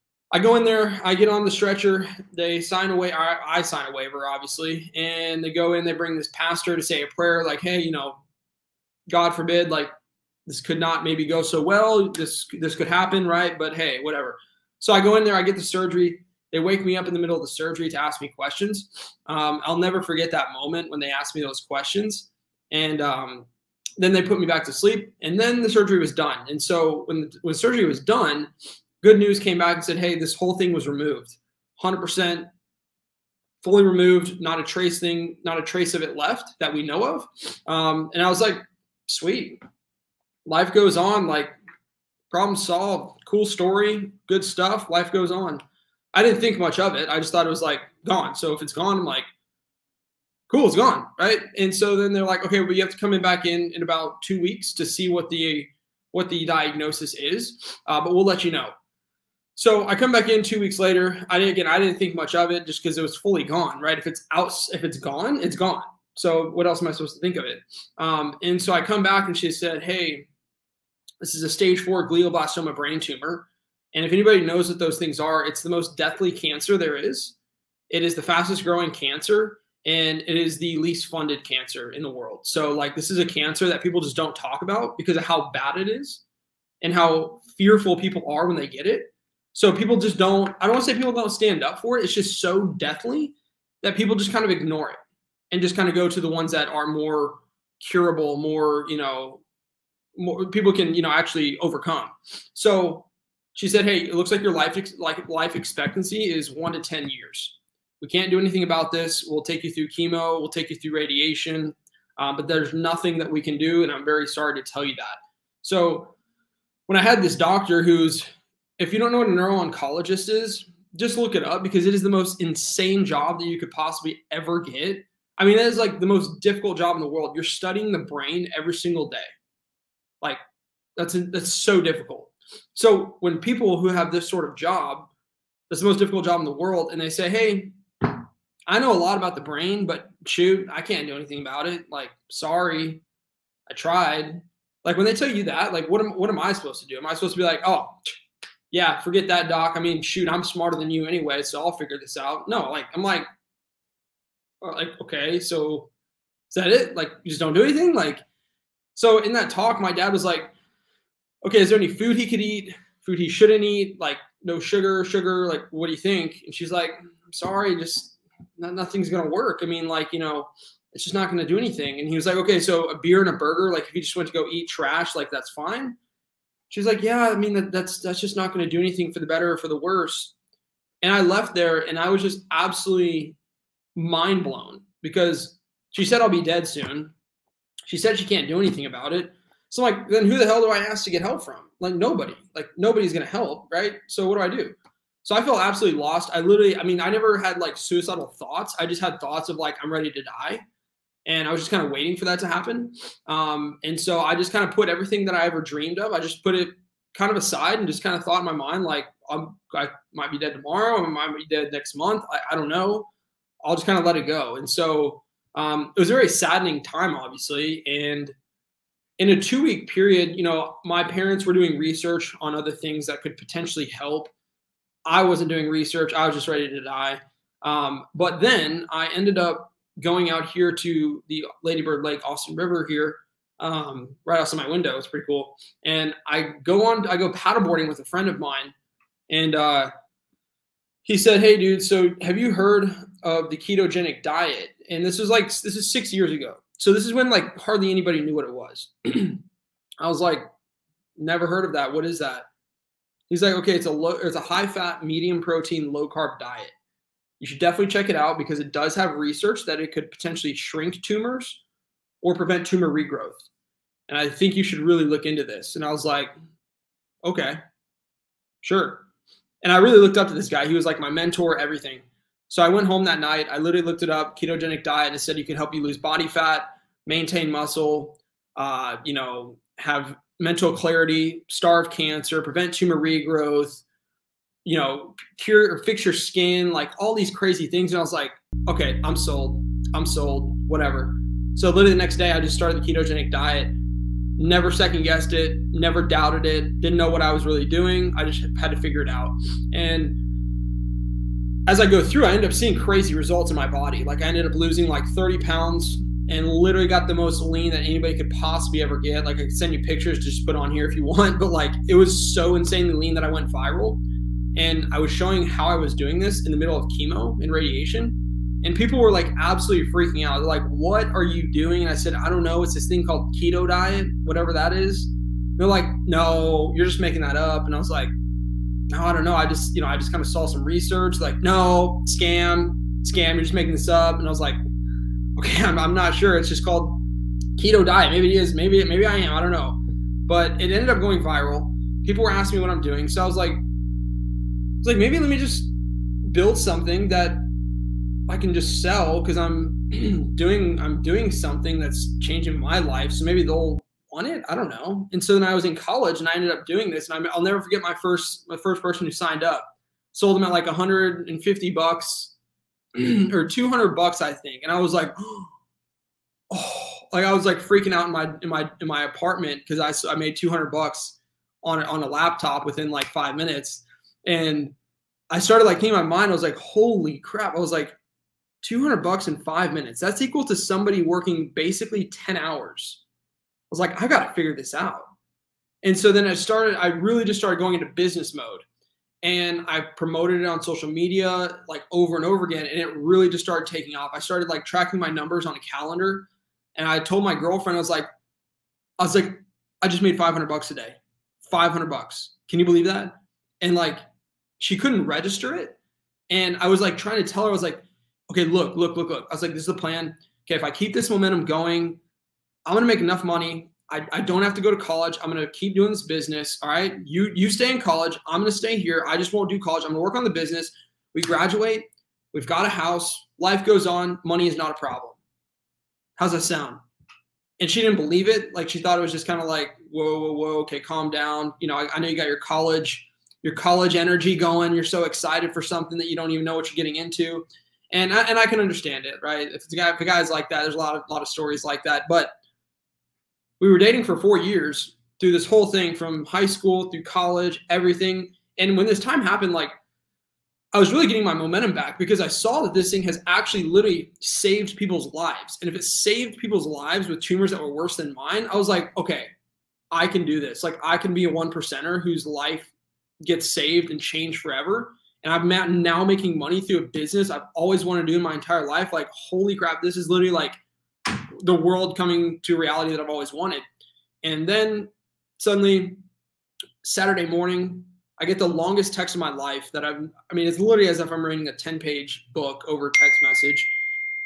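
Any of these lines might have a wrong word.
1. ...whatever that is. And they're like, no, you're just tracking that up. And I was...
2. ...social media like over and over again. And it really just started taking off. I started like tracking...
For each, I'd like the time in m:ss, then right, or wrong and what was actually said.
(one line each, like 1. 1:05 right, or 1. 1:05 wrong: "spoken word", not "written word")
1. 5:24 wrong: "making", not "tracking"
2. 6:30 right.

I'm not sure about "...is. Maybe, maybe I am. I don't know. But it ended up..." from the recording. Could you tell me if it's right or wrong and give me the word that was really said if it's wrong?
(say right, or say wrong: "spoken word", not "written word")
right.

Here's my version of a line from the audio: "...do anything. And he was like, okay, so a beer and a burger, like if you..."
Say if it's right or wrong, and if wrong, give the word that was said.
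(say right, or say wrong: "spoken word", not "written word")
right.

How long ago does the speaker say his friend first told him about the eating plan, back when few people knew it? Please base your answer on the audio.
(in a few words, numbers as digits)
6 years ago.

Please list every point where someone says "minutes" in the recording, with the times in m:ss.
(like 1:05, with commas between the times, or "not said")
6:13, 6:19.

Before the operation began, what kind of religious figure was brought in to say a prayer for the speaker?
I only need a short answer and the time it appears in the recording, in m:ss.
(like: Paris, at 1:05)
pastor, at 0:06.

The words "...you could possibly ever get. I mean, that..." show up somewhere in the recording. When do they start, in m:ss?
2:03.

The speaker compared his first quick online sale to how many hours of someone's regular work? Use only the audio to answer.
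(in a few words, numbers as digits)
10 hours.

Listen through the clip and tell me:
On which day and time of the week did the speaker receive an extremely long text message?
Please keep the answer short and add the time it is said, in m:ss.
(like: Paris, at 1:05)
Saturday morning, at 7:56.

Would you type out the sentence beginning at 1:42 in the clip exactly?
So she said, "Hey, it looks like your life ex- like life expectancy is 1 to 10 years.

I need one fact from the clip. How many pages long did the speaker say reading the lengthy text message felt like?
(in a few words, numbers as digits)
10.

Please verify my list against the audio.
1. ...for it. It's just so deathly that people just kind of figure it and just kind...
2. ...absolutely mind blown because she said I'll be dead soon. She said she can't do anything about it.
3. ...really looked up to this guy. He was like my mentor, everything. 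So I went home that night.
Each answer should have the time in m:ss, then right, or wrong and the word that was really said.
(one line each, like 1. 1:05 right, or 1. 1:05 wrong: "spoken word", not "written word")
1. 1:31 wrong: "ignore", not "figure"
2. 3:02 right
3. 4:29 right.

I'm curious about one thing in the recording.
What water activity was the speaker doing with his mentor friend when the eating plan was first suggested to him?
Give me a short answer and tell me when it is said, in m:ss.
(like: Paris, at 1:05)
paddleboarding, at 3:57.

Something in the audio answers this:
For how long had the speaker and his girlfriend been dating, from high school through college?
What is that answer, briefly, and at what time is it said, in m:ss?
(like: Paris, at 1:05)
4 years, at 7:24.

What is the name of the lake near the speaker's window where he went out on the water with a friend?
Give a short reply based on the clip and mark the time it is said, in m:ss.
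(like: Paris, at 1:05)
Ladybird Lake, at 3:51.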